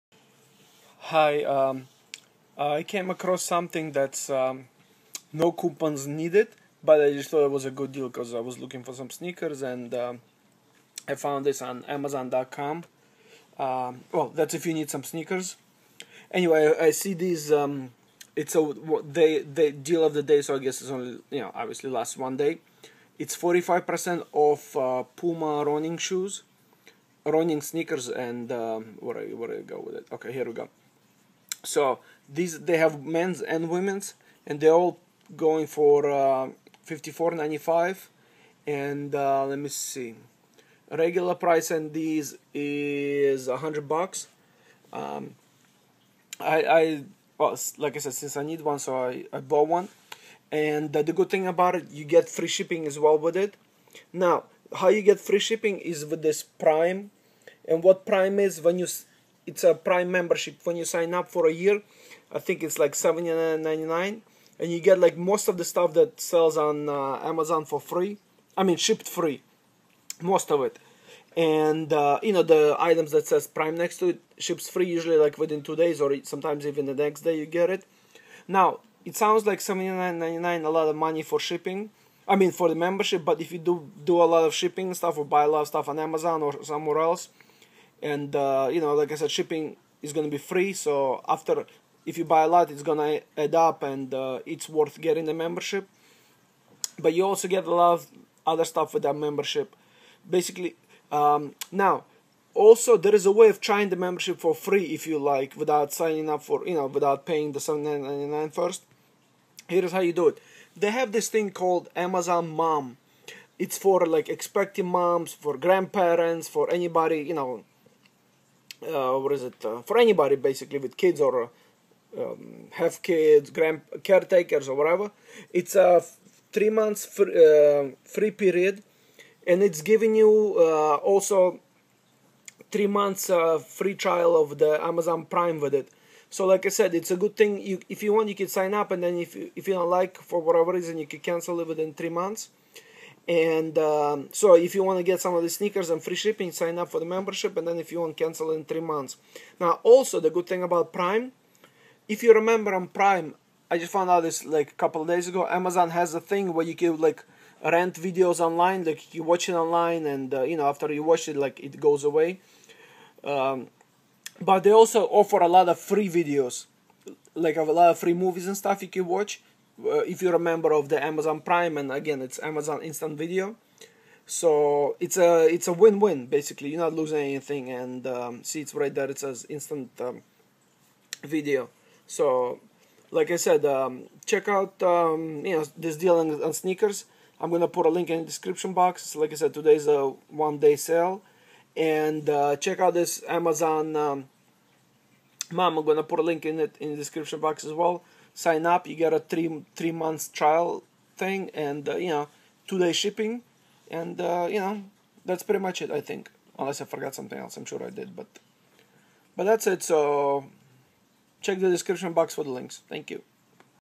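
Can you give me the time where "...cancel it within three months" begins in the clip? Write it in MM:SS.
02:21.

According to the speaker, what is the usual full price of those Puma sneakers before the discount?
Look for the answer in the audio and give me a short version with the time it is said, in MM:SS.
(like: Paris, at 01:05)
$100, at 00:43.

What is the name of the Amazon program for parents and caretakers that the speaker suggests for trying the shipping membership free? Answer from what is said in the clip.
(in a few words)
Amazon Mom.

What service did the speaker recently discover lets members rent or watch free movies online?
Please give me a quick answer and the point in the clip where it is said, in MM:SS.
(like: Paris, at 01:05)
Amazon Instant Video, at 02:52.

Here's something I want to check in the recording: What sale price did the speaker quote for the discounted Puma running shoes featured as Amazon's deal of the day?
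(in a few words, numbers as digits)
$54.95.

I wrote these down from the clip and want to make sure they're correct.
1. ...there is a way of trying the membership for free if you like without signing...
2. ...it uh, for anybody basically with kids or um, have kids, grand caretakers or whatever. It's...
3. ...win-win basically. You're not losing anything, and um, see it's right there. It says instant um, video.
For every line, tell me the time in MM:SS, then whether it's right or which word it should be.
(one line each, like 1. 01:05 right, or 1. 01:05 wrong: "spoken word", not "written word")
1. 01:42 right
2. 01:59 right
3. 02:55 right.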